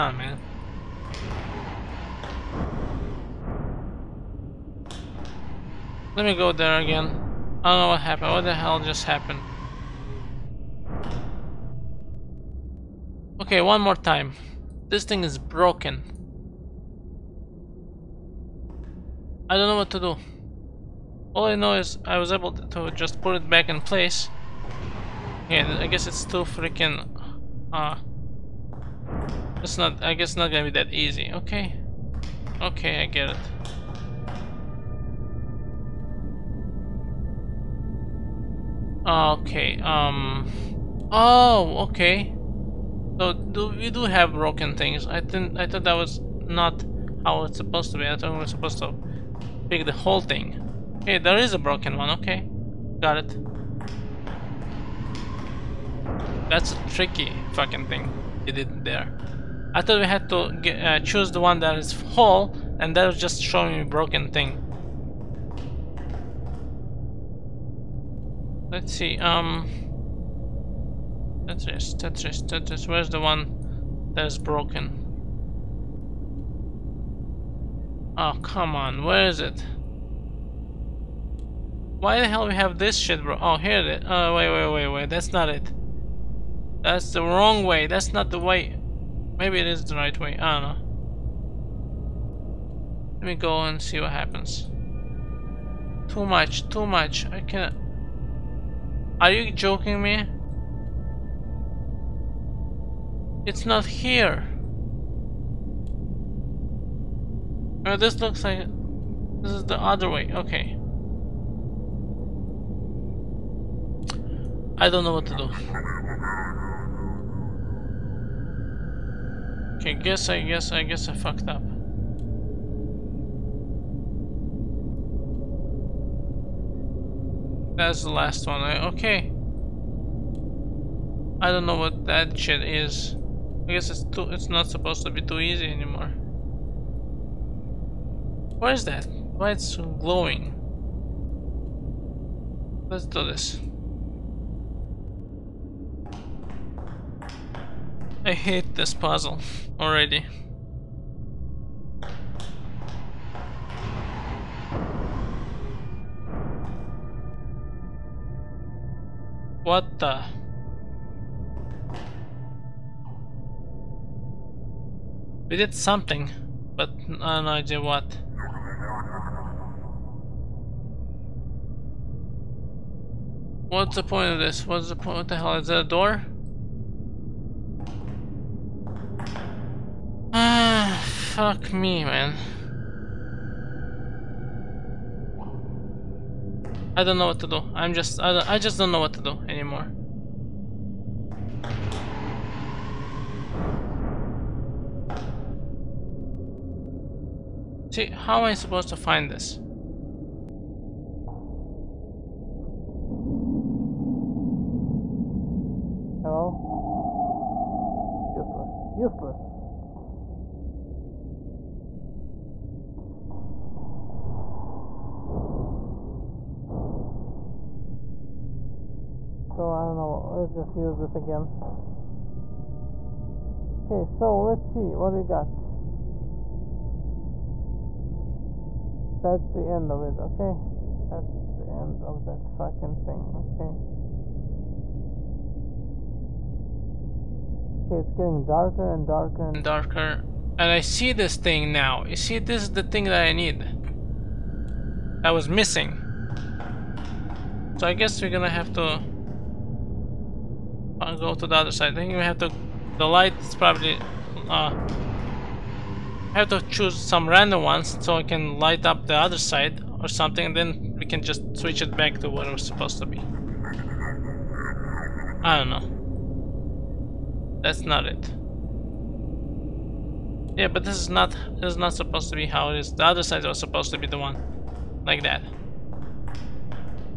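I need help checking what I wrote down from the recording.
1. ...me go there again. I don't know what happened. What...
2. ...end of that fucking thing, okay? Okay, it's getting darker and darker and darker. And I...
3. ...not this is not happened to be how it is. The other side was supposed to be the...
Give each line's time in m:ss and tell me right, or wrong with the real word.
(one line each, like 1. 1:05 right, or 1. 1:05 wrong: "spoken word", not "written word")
1. 0:06 right
2. 3:51 right
3. 4:31 wrong: "supposed", not "happened".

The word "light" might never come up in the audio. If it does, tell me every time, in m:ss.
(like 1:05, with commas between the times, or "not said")
4:13, 4:18.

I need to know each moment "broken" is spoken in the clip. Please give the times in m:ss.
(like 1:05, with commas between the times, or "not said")
0:15, 0:44, 0:51, 1:03, 1:14.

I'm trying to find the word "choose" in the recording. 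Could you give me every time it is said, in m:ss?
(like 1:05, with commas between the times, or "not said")
1:00, 4:16.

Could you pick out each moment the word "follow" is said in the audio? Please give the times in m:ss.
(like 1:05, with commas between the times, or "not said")
not said.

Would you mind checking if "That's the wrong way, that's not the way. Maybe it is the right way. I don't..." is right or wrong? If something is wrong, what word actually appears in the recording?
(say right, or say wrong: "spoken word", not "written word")
right.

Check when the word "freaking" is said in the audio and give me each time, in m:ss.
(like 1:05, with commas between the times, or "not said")
0:26.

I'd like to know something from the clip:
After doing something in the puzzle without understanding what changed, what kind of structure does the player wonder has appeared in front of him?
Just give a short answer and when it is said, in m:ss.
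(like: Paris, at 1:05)
door, at 2:55.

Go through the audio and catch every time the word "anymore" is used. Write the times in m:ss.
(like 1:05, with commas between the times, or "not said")
2:15, 3:09.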